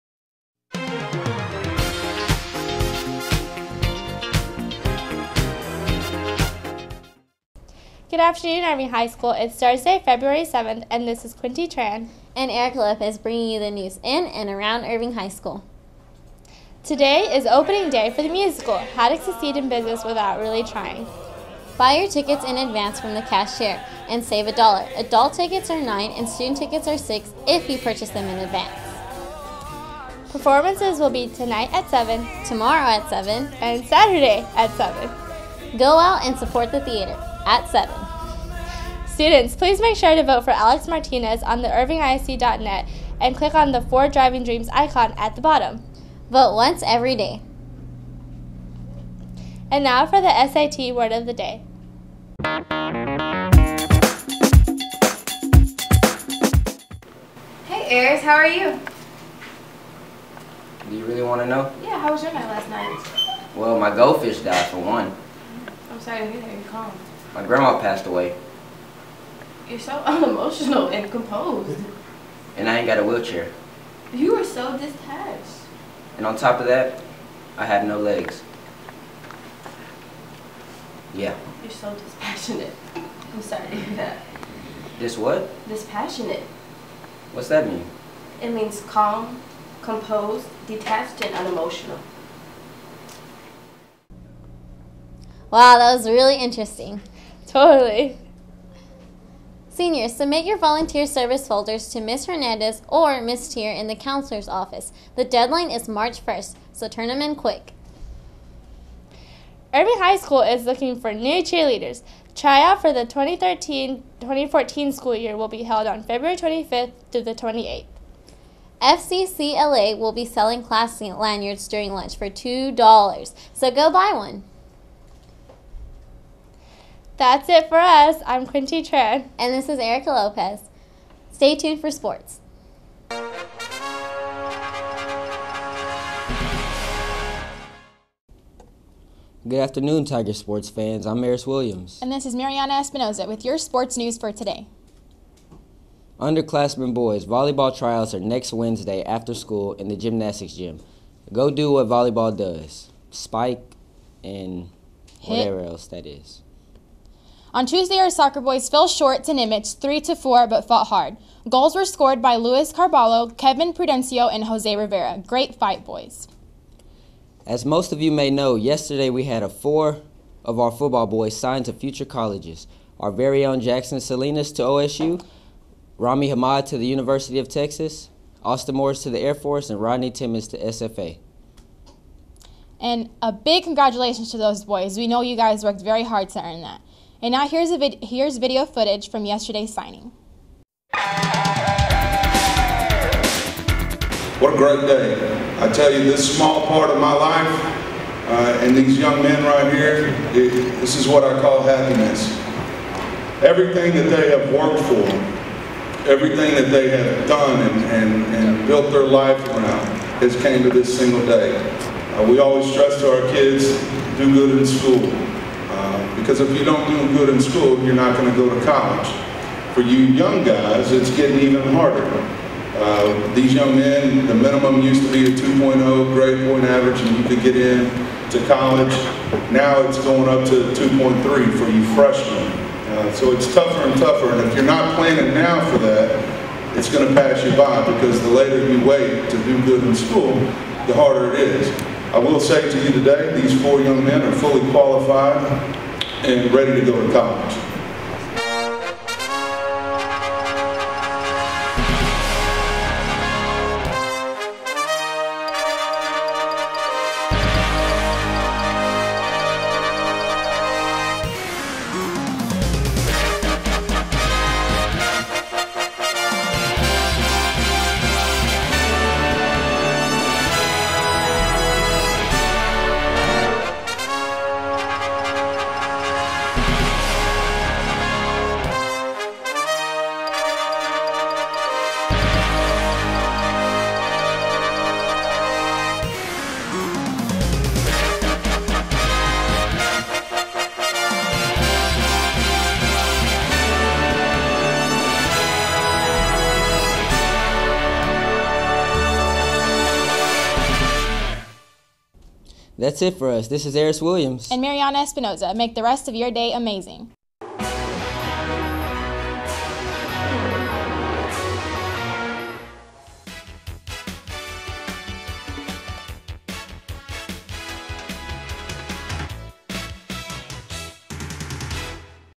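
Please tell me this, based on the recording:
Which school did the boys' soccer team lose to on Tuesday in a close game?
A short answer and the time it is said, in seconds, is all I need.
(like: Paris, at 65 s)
Nimitz, at 159 s.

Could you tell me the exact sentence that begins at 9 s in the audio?
It's Thursday, February 7th, and this is Quinty Tran.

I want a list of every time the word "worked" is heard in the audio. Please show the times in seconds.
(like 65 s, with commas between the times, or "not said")
185 s, 204 s.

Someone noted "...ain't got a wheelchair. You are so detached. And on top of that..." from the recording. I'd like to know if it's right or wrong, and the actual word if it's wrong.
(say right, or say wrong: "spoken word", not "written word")
right.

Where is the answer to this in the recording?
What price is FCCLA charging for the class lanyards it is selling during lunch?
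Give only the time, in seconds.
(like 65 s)
122 s.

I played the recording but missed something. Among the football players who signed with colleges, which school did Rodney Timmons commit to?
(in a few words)
SFA.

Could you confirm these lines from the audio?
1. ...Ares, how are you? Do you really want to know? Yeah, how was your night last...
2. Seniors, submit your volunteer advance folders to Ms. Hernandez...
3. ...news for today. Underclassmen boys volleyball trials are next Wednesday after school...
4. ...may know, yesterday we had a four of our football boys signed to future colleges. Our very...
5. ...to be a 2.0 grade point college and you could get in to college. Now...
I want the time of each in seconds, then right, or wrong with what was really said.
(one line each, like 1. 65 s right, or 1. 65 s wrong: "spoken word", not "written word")
1. 58 s right
2. 99 s wrong: "service", not "advance"
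3. 143 s right
4. 168 s right
5. 225 s wrong: "average", not "college".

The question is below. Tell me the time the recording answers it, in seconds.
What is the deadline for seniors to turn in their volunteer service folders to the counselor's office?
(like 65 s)
105 s.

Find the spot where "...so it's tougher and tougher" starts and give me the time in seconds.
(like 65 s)
233 s.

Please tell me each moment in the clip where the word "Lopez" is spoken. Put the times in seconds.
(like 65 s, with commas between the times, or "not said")
12 s, 130 s.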